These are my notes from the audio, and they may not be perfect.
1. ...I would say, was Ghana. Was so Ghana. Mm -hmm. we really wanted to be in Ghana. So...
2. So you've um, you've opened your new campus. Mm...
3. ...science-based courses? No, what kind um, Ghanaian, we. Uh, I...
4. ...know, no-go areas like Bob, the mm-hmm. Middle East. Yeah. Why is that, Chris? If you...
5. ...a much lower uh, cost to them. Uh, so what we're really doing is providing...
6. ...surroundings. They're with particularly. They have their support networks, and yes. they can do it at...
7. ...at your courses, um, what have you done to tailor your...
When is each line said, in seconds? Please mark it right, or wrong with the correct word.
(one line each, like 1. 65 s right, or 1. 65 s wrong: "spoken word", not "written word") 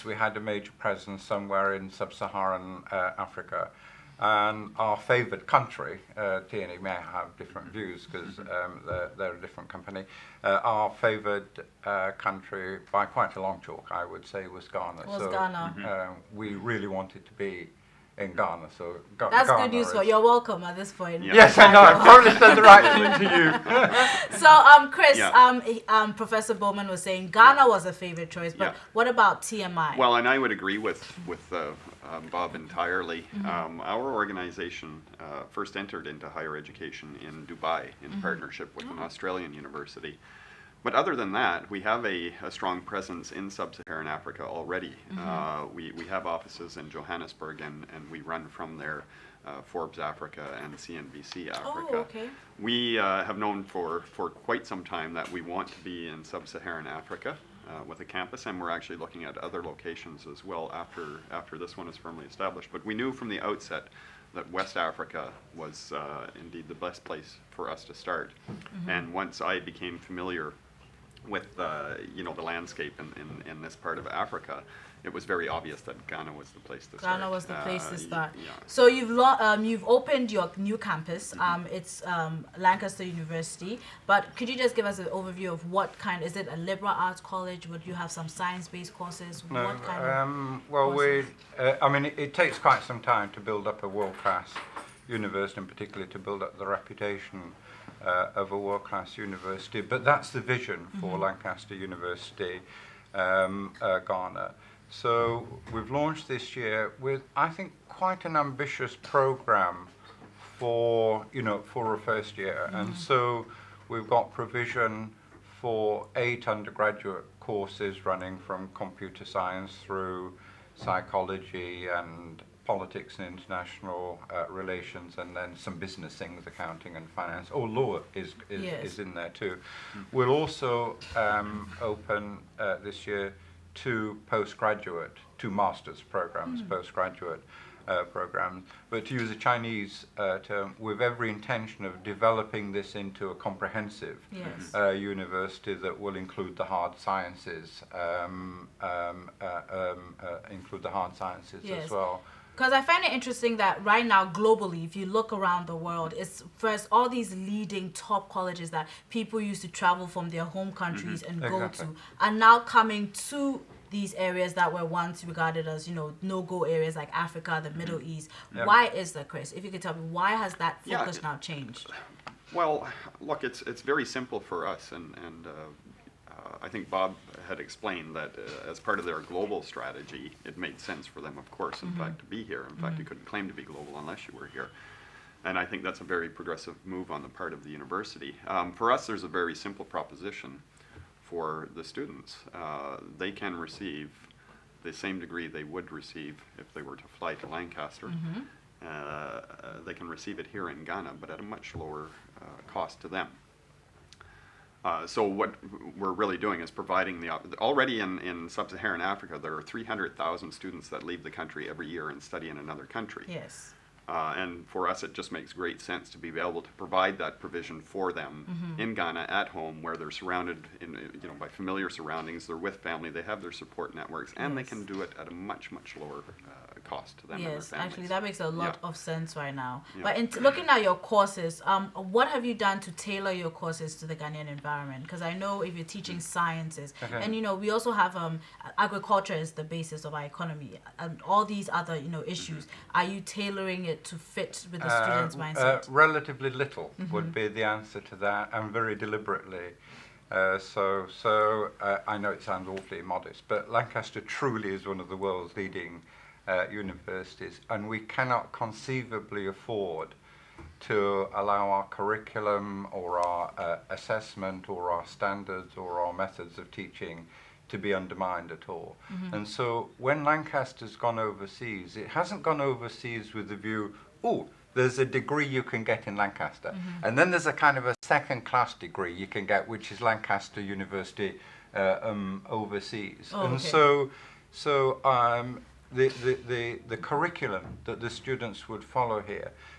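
1. 13 s right
2. 78 s right
3. 88 s wrong: "Well", not "Ghanaian"
4. 165 s wrong: "Africa", not "Bob"
5. 201 s right
6. 221 s wrong: "family", not "particularly"
7. 230 s right.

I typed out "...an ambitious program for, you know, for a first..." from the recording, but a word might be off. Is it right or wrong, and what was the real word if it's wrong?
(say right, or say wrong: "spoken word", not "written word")
right.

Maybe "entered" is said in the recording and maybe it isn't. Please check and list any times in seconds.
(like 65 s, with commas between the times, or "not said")
35 s.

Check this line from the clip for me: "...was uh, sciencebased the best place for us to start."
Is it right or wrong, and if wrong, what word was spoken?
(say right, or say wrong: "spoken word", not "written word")
wrong: "indeed", not "sciencebased".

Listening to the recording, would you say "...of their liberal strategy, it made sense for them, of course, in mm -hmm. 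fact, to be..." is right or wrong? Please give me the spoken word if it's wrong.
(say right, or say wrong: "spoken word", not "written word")
wrong: "global", not "liberal".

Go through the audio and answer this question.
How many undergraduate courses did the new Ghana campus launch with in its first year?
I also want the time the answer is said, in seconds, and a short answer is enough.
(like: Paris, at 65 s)
8, at 116 s.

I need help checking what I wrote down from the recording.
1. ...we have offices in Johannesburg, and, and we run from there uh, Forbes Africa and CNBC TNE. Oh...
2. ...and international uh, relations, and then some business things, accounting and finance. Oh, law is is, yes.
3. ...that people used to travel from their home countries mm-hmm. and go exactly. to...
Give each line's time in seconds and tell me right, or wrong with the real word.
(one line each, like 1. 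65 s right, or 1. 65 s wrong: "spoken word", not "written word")
1. 45 s wrong: "Africa", not "TNE"
2. 123 s right
3. 158 s right.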